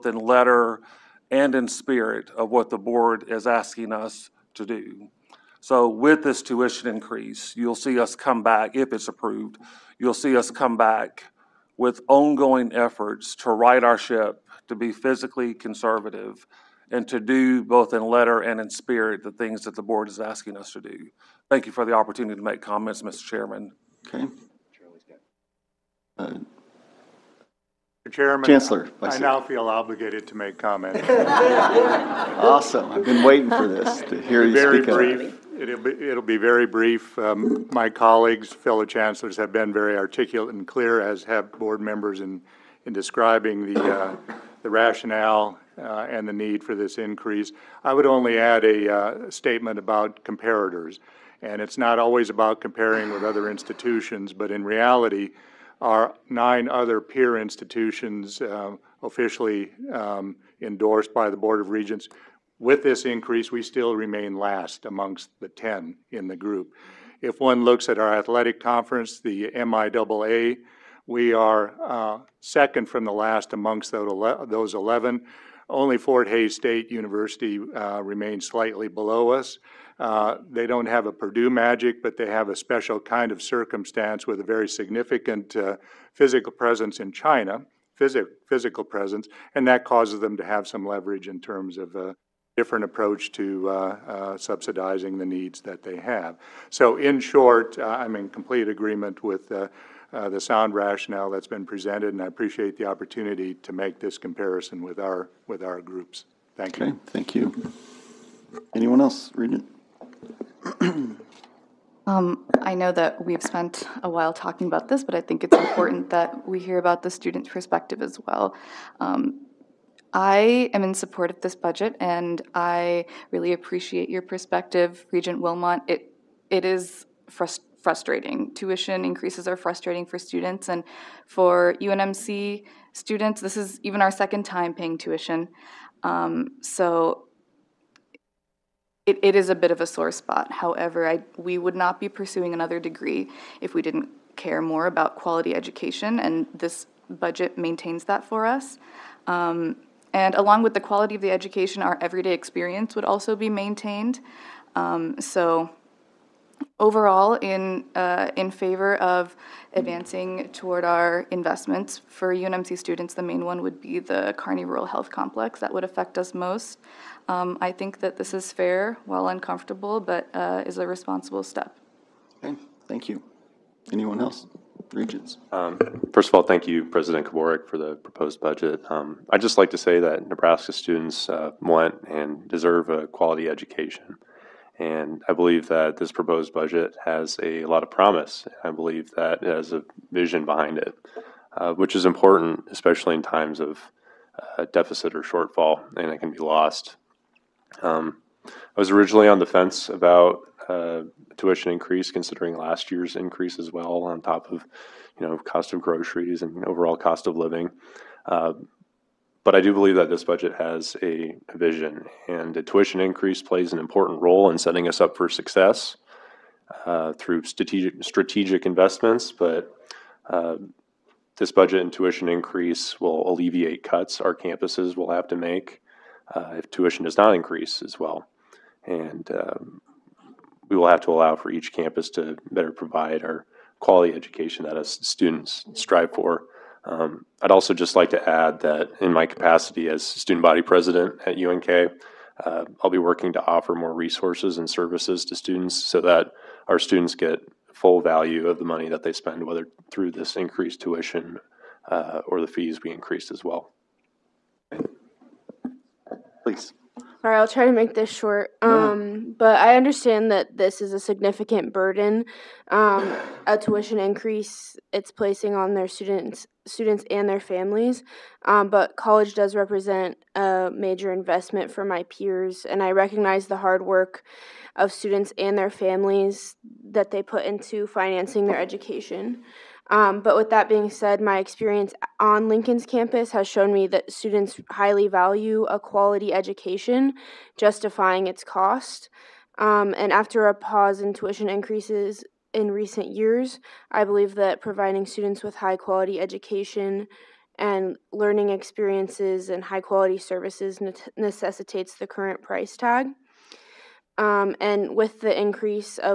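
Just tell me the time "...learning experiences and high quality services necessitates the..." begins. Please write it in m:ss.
4:58.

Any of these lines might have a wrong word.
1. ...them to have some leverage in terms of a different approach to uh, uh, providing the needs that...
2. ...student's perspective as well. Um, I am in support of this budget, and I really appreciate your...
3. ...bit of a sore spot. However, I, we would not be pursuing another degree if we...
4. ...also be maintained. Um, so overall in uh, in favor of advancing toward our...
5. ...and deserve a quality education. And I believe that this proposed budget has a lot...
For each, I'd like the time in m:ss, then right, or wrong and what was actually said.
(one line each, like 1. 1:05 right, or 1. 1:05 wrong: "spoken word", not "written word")
1. 1:30 wrong: "subsidizing", not "providing"
2. 1:57 right
3. 2:19 right
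4. 2:33 right
5. 3:02 right.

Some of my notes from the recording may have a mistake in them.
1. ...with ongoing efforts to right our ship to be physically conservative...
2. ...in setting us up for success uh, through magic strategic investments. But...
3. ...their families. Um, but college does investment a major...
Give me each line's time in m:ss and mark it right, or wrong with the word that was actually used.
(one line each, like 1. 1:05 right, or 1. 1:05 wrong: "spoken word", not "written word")
1. 0:11 right
2. 3:34 wrong: "strategic", not "magic"
3. 4:27 wrong: "represent", not "investment".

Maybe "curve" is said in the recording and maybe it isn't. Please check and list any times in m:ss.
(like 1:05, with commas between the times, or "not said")
not said.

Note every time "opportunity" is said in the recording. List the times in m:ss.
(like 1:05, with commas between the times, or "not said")
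0:21, 1:42.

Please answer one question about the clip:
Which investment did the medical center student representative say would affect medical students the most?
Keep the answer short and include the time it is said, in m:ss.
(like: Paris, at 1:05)
Kearney Rural Health Complex, at 2:44.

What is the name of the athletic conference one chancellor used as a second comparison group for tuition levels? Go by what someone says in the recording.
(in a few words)
MIAA.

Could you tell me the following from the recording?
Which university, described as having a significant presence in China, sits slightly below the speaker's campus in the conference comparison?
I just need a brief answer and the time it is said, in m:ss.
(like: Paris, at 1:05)
Fort Hays State University, at 1:15.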